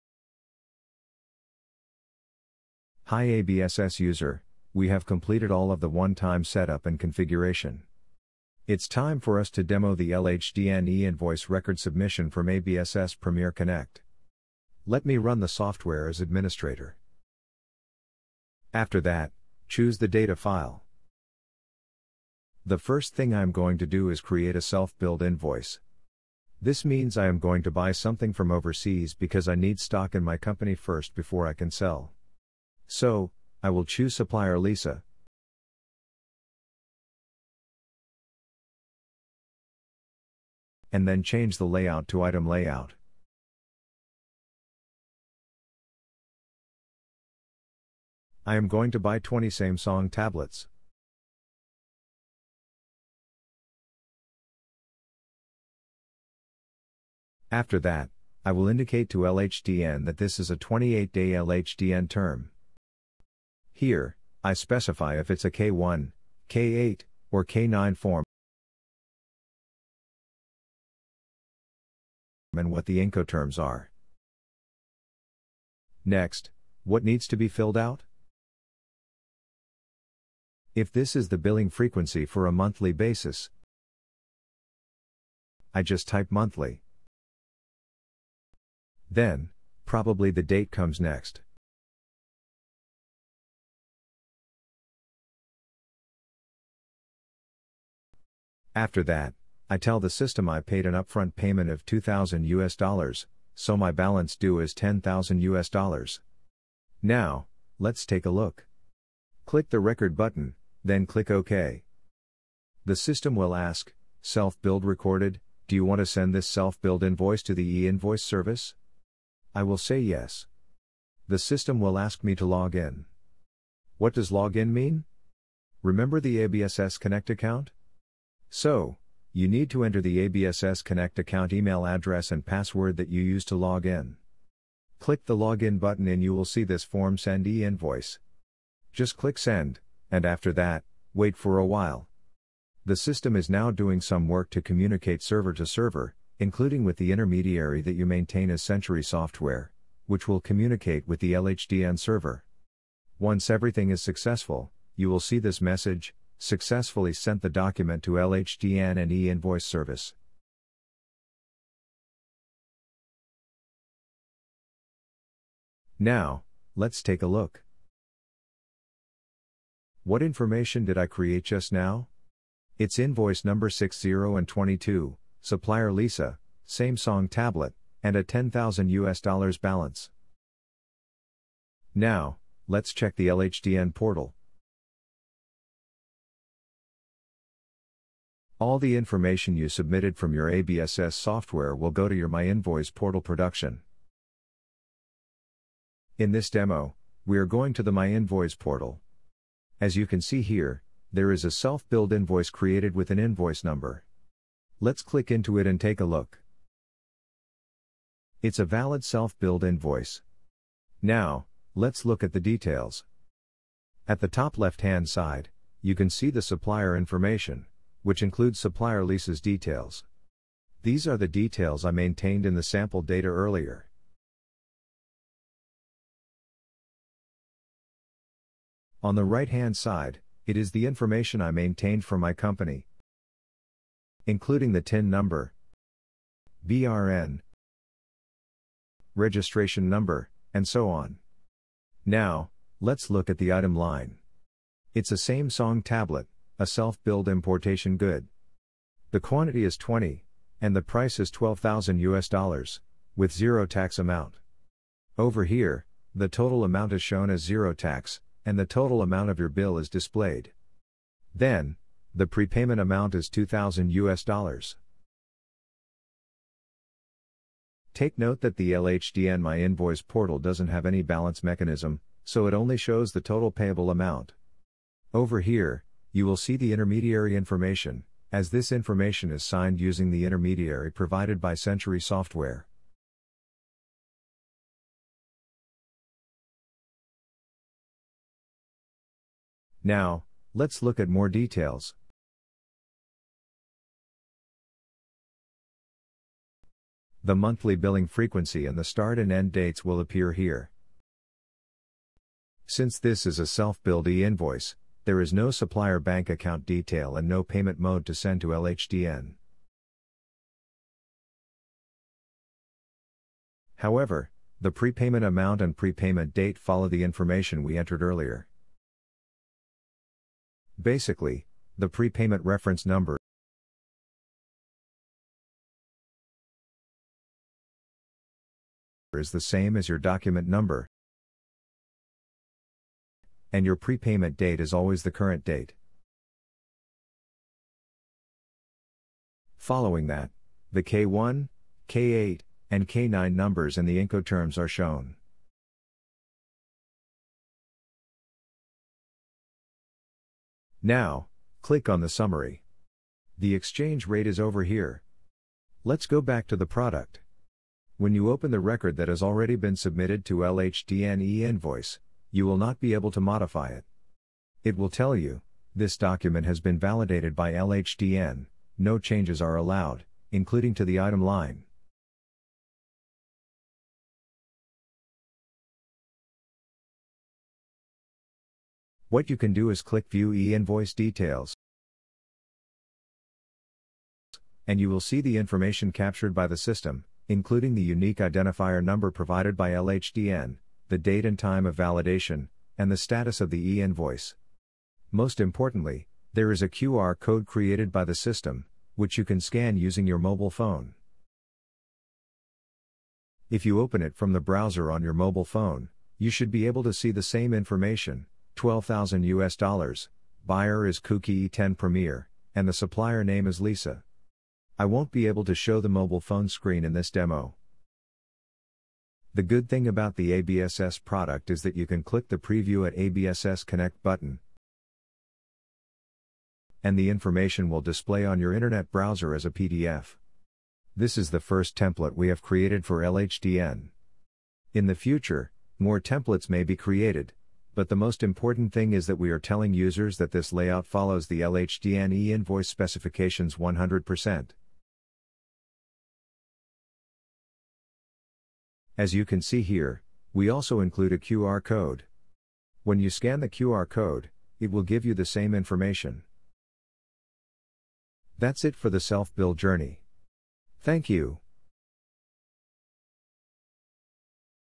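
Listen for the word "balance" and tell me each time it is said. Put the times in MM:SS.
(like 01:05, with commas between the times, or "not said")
01:43, 02:59, 04:31.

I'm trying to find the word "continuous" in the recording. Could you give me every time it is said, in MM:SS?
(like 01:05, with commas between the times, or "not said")
not said.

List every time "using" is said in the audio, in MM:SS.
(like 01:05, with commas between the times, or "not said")
04:39, 06:39.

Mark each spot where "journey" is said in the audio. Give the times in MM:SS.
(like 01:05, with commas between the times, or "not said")
07:39.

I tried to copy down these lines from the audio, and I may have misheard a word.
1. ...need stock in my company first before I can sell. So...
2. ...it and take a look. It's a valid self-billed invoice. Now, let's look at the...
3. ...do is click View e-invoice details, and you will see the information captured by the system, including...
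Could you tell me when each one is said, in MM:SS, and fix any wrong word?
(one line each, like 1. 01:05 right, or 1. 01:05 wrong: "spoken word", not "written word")
1. 00:29 right
2. 03:25 right
3. 06:19 right.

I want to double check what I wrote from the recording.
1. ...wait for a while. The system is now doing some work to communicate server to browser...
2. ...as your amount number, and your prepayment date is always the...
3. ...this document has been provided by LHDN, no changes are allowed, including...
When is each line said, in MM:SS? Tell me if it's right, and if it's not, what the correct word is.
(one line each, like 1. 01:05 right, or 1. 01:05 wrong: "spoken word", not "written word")
1. 02:21 wrong: "server", not "browser"
2. 05:29 wrong: "document", not "amount"
3. 06:05 wrong: "validated", not "provided".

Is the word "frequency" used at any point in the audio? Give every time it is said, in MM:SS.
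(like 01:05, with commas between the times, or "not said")
01:21, 04:58.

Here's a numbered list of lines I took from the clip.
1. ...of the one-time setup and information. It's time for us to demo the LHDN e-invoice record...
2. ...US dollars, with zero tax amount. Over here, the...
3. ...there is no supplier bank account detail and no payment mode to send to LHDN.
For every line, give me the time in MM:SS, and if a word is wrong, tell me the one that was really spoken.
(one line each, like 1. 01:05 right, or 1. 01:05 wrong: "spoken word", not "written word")
1. 00:05 wrong: "configuration", not "information"
2. 04:12 right
3. 05:05 right.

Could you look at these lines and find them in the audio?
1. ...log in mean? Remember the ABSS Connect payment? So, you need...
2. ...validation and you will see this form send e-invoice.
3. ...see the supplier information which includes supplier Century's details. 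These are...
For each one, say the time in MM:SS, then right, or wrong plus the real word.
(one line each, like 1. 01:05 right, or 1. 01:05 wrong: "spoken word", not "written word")
1. 02:04 wrong: "account", not "payment"
2. 02:15 wrong: "button", not "validation"
3. 03:36 wrong: "Lisa", not "Century".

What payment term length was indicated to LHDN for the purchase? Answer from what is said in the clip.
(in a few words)
28 days.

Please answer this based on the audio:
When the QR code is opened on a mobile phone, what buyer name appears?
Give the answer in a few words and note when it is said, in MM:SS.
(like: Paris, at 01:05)
Kuki E10 Premier, at 06:50.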